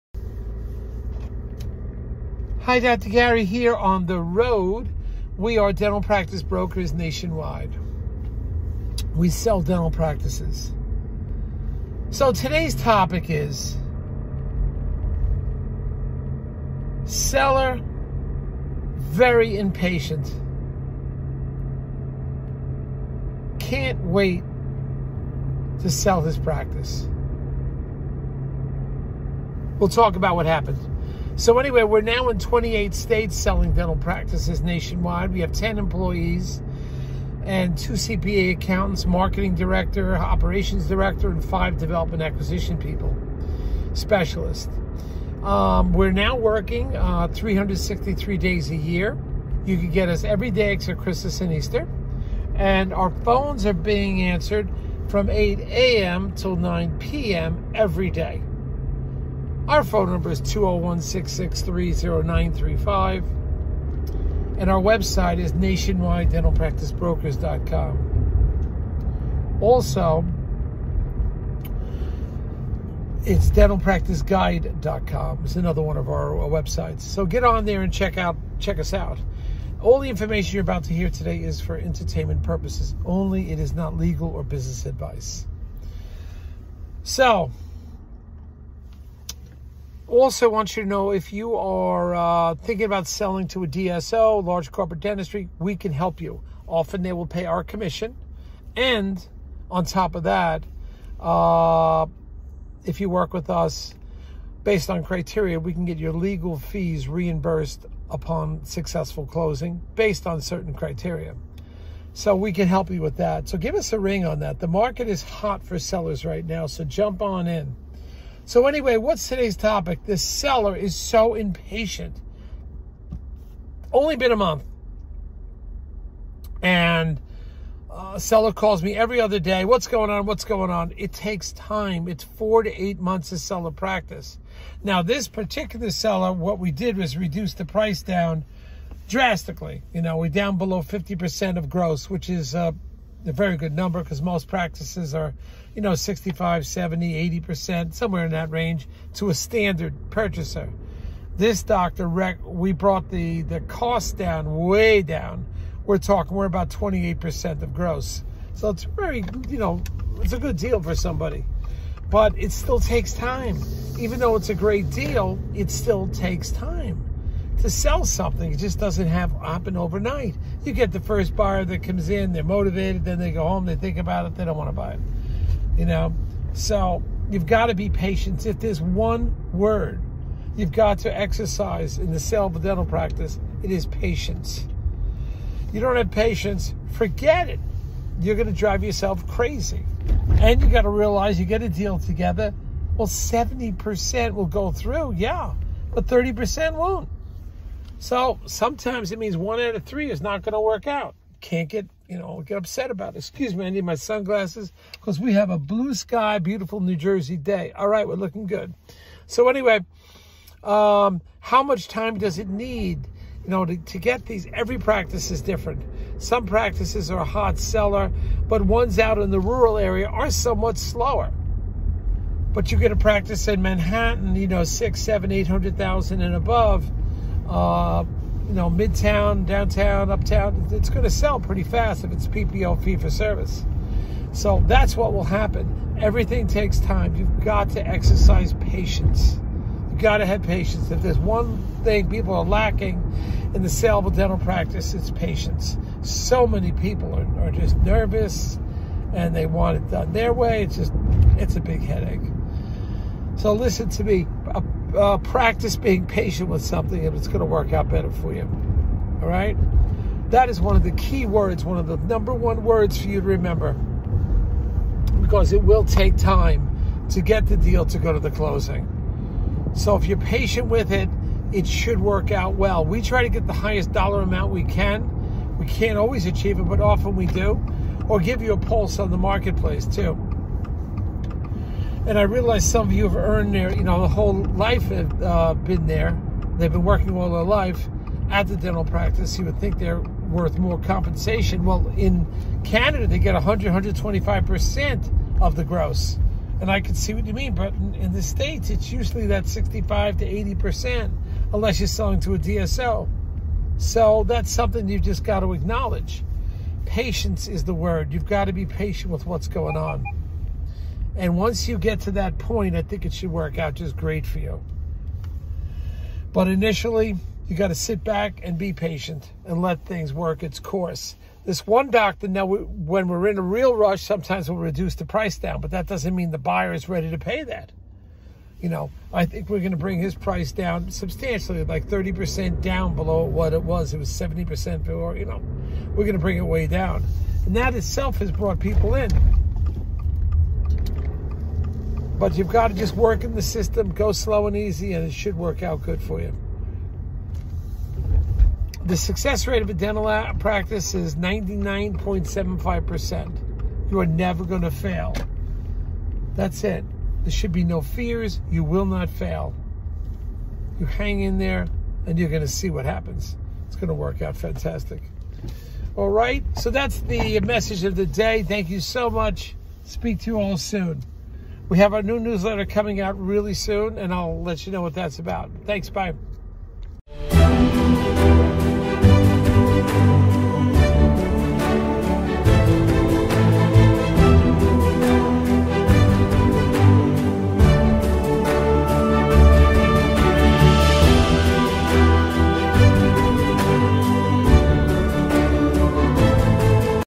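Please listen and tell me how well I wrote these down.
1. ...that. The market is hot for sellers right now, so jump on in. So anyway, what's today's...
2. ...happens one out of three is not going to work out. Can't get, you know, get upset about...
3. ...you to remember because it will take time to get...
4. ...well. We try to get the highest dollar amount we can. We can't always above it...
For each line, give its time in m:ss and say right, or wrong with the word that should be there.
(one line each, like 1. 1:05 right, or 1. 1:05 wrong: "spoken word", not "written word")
1. 1:54 right
2. 3:19 wrong: "means", not "happens"
3. 4:23 right
4. 4:32 wrong: "achieve", not "above".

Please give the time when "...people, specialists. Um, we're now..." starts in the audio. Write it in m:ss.
0:42.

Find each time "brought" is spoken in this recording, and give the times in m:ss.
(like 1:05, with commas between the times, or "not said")
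2:32, 5:38.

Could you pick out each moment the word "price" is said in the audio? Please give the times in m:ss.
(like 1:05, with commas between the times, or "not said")
2:17, 5:25, 5:30.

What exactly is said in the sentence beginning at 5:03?
So that's something you've just got to acknowledge.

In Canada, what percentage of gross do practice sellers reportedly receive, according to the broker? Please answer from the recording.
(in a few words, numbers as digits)
100-125%.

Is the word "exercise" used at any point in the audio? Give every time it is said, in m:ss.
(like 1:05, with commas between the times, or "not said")
3:01, 3:57.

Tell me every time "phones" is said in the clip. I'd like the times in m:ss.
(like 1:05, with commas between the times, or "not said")
0:53, 0:59.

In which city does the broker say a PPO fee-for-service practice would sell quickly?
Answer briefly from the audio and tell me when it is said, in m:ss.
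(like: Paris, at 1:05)
Manhattan, at 3:43.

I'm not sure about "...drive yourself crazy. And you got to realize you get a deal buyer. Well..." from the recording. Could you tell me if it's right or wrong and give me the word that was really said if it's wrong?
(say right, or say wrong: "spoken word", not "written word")
wrong: "together", not "buyer".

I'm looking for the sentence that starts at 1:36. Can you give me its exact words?
Often they will pay our commission.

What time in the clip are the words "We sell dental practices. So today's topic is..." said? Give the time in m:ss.
0:09.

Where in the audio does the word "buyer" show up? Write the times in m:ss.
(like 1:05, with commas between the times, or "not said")
2:51, 5:26.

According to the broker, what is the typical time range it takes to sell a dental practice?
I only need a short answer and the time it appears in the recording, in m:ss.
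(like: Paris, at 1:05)
4 to 8 months, at 2:12.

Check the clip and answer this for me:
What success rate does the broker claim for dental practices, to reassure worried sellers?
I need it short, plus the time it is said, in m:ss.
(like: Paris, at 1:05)
99.75%, at 5:51.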